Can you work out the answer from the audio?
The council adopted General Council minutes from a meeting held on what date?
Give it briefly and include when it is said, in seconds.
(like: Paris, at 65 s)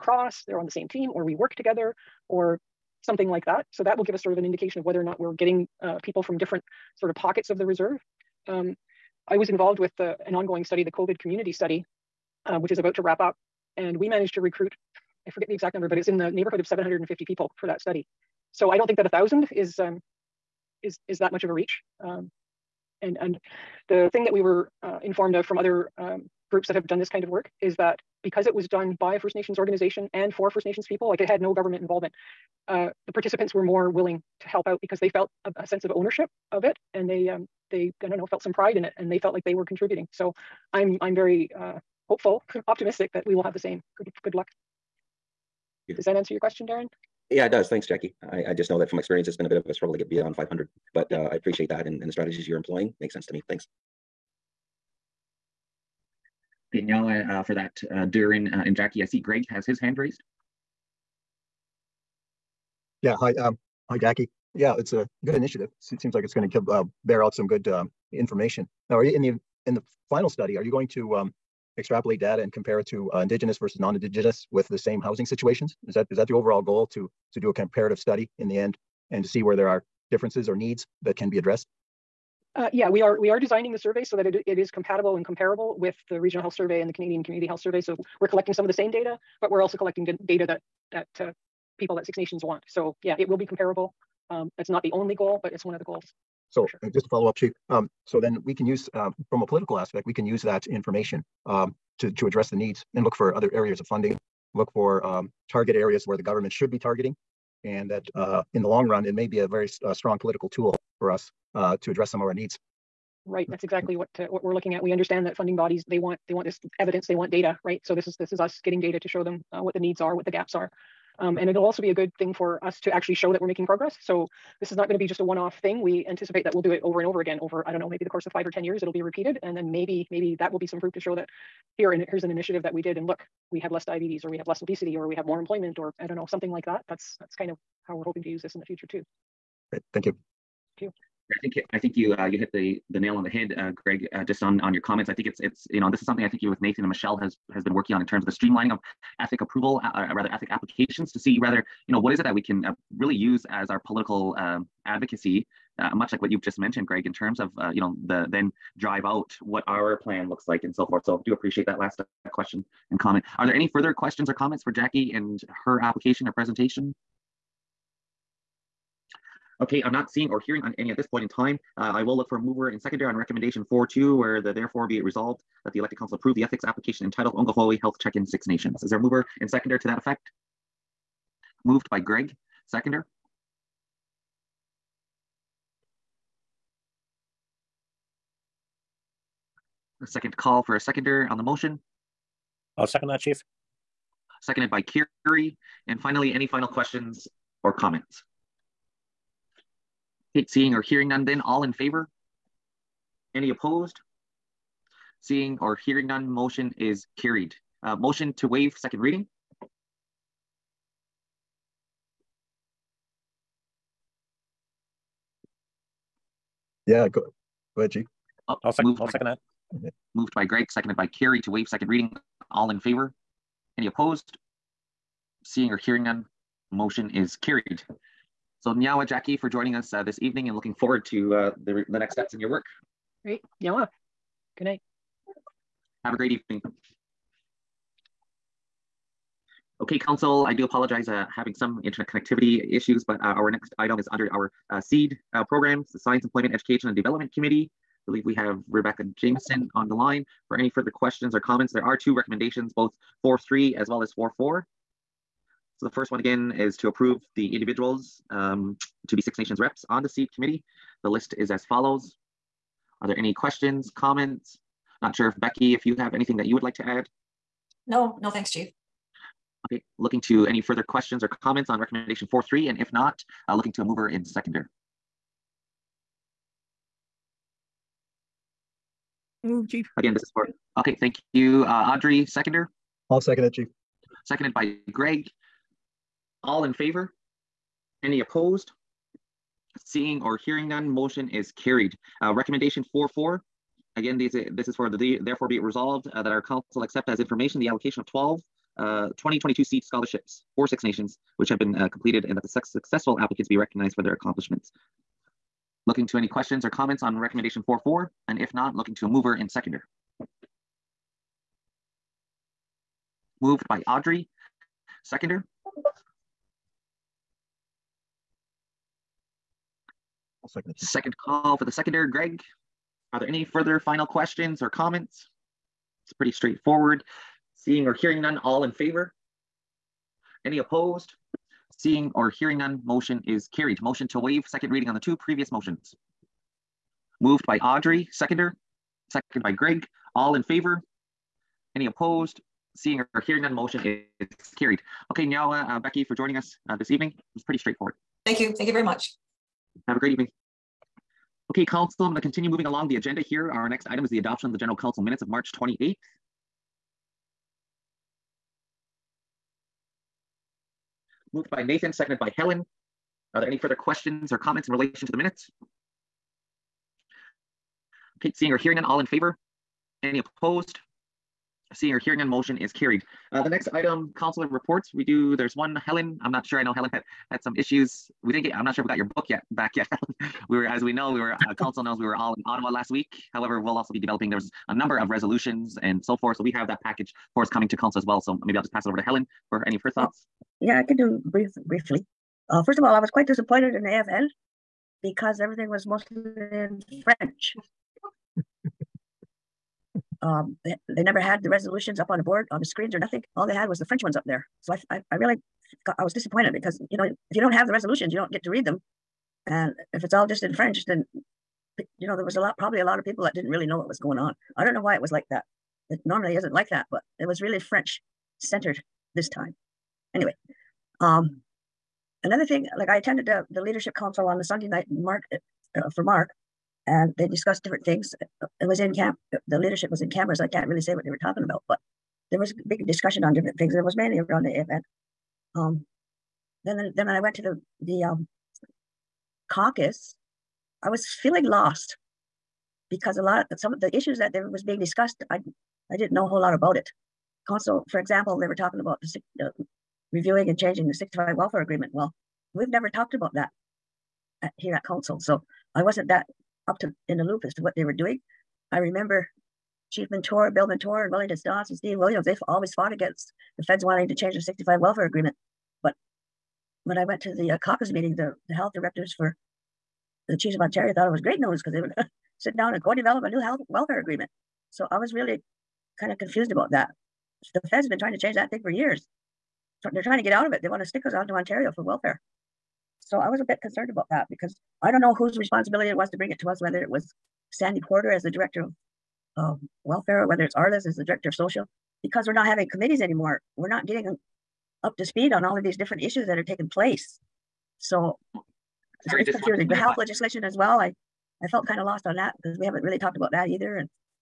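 March 28th, at 355 s.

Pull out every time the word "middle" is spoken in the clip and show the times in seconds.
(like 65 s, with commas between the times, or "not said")
not said.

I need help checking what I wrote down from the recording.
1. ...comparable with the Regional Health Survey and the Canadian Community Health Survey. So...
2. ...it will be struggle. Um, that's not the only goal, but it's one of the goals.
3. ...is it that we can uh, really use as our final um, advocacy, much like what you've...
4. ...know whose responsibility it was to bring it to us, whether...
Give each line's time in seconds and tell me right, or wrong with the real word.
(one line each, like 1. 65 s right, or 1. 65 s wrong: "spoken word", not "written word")
1. 85 s right
2. 93 s wrong: "comparable", not "struggle"
3. 152 s wrong: "political", not "final"
4. 485 s right.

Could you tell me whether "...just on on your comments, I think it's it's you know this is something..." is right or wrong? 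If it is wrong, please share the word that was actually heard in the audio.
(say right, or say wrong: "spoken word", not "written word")
right.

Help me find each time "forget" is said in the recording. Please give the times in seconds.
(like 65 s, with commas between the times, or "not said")
15 s.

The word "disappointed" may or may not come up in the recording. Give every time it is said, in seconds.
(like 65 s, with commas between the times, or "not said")
393 s, 406 s.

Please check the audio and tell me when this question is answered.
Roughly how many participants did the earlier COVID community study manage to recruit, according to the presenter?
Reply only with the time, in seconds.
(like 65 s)
16 s.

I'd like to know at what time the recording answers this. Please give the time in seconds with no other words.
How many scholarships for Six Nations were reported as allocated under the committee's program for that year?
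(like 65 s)
298 s.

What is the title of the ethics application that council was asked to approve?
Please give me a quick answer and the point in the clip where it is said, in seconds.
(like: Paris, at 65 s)
Ongahoi Health Check-in Six Nations, at 177 s.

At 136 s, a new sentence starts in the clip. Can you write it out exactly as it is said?
That's, that's kind of how we're hoping to use this in the future too.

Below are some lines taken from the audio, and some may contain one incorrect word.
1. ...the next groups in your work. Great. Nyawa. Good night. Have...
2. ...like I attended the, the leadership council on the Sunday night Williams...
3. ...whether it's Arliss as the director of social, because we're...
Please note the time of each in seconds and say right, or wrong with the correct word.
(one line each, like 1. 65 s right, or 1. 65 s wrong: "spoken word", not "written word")
1. 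231 s wrong: "steps", not "groups"
2. 422 s wrong: "Mark", not "Williams"
3. 490 s right.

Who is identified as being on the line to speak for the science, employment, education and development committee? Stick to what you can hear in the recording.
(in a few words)
Rebecca Jameson.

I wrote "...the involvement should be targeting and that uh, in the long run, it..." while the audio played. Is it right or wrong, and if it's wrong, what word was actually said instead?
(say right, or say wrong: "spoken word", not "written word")
wrong: "government", not "involvement".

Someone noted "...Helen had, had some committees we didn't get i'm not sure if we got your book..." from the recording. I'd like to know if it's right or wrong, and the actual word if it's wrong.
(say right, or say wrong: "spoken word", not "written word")
wrong: "issues", not "committees".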